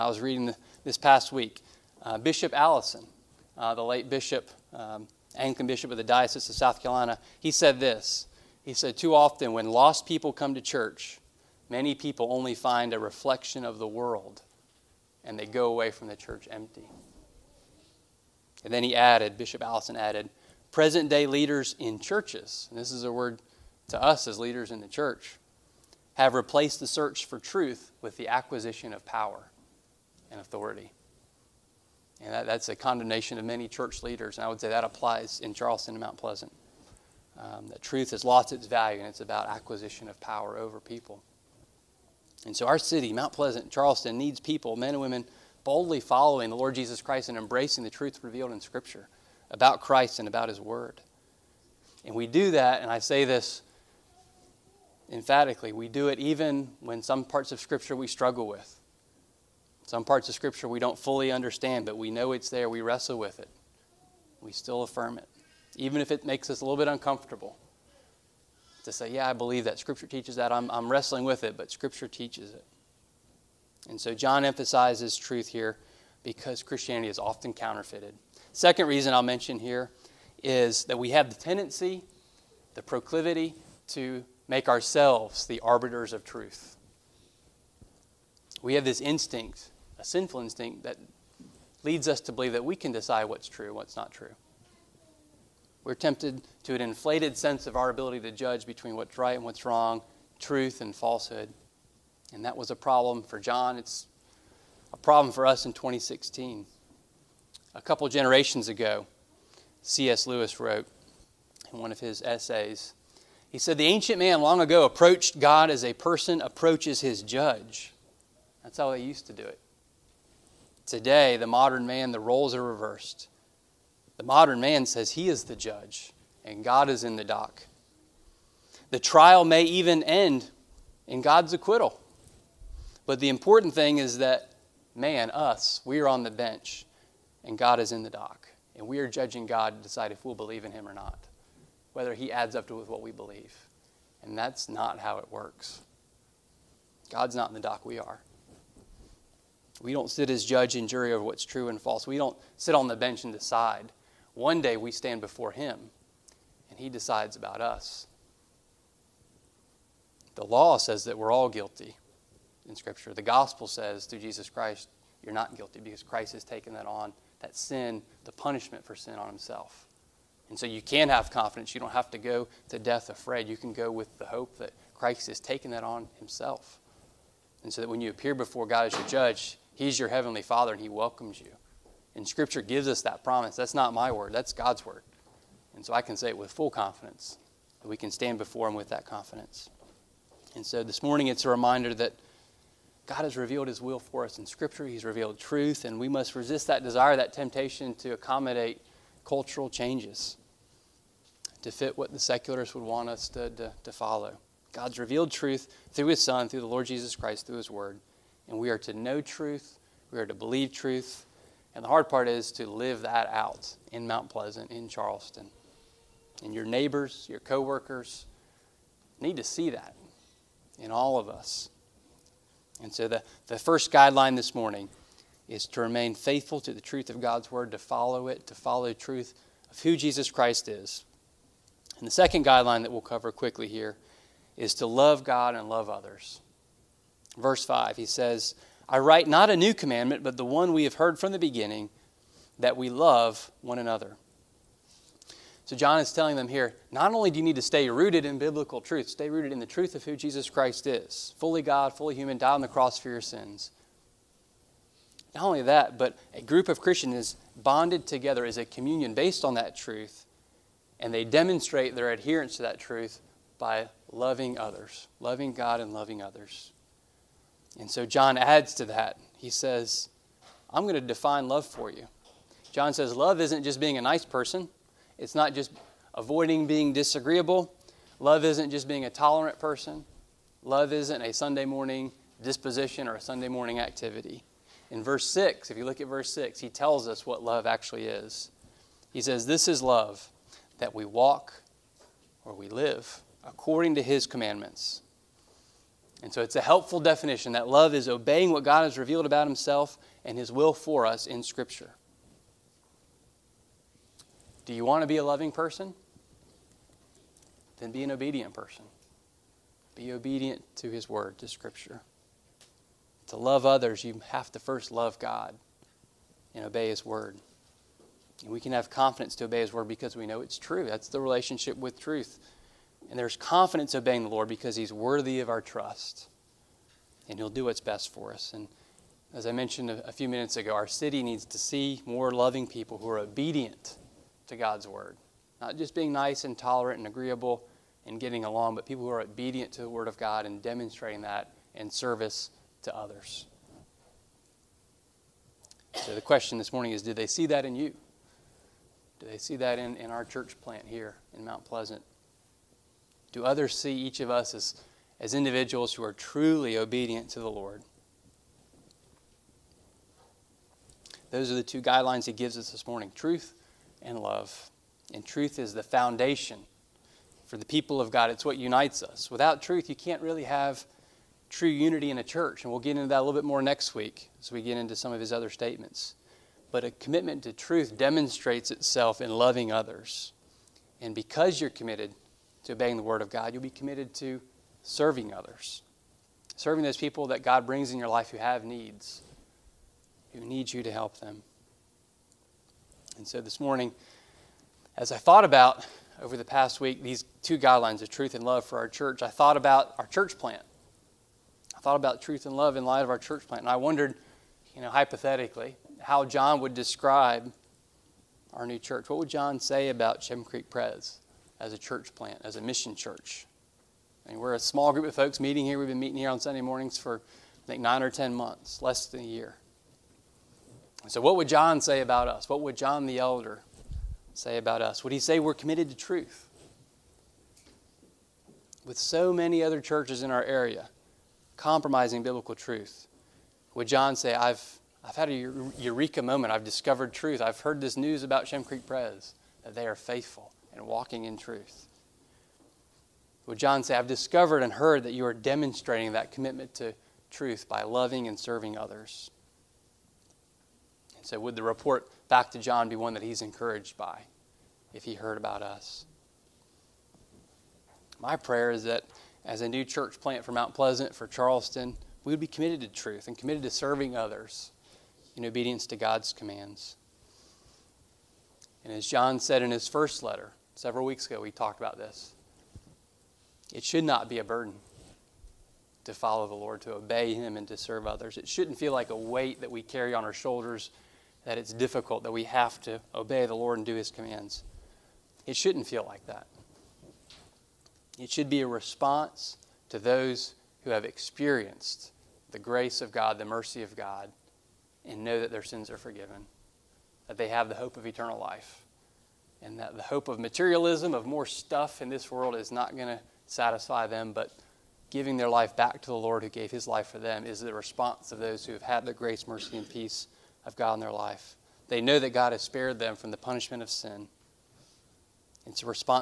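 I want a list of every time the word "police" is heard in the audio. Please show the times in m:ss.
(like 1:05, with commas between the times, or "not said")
not said.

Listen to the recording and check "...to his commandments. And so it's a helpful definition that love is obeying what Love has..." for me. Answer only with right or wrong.
wrong.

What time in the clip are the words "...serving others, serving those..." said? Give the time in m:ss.
6:24.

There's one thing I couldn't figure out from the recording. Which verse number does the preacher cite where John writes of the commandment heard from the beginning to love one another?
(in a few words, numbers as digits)
Verse 5.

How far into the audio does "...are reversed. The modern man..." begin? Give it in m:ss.
2:02.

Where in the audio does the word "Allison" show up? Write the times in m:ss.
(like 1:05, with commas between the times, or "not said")
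0:02, 0:19.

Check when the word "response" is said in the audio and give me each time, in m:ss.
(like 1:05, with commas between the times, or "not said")
8:08, 8:27.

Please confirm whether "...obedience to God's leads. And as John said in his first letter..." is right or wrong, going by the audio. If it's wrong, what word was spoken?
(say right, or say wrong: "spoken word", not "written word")
wrong: "commands", not "leads".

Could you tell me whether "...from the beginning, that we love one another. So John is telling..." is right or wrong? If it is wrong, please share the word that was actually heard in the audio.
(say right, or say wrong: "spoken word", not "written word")
right.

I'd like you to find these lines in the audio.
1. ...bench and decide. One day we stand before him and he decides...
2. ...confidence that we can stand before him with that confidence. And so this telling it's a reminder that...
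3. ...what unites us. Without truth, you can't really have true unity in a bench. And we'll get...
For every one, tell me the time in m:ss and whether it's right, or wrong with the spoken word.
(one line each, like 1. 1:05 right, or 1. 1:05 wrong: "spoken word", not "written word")
1. 2:32 right
2. 3:06 wrong: "morning", not "telling"
3. 6:08 wrong: "church", not "bench".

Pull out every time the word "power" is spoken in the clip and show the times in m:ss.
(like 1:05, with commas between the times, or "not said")
0:29, 0:40.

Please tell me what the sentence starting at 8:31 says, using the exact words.
They know that God has spared them from the punishment of sin.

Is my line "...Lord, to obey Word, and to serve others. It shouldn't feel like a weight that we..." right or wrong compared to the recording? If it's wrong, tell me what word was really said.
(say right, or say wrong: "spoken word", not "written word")
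wrong: "Him", not "Word".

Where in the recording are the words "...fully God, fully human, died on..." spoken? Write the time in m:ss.
4:11.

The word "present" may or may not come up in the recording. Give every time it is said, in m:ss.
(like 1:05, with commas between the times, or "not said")
0:20.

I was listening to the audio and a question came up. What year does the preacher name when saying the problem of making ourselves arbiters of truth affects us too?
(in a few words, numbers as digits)
2016.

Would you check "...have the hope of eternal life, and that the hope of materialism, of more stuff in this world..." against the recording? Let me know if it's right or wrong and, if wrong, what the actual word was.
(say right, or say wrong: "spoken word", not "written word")
right.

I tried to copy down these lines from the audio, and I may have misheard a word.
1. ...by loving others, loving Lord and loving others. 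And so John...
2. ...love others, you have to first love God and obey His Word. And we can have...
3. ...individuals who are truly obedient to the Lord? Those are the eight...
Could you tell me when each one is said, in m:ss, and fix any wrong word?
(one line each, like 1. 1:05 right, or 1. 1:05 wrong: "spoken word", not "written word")
1. 4:23 wrong: "God", not "Lord"
2. 5:13 right
3. 5:55 wrong: "two", not "eight".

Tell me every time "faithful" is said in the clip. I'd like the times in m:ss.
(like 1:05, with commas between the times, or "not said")
3:46, 7:19.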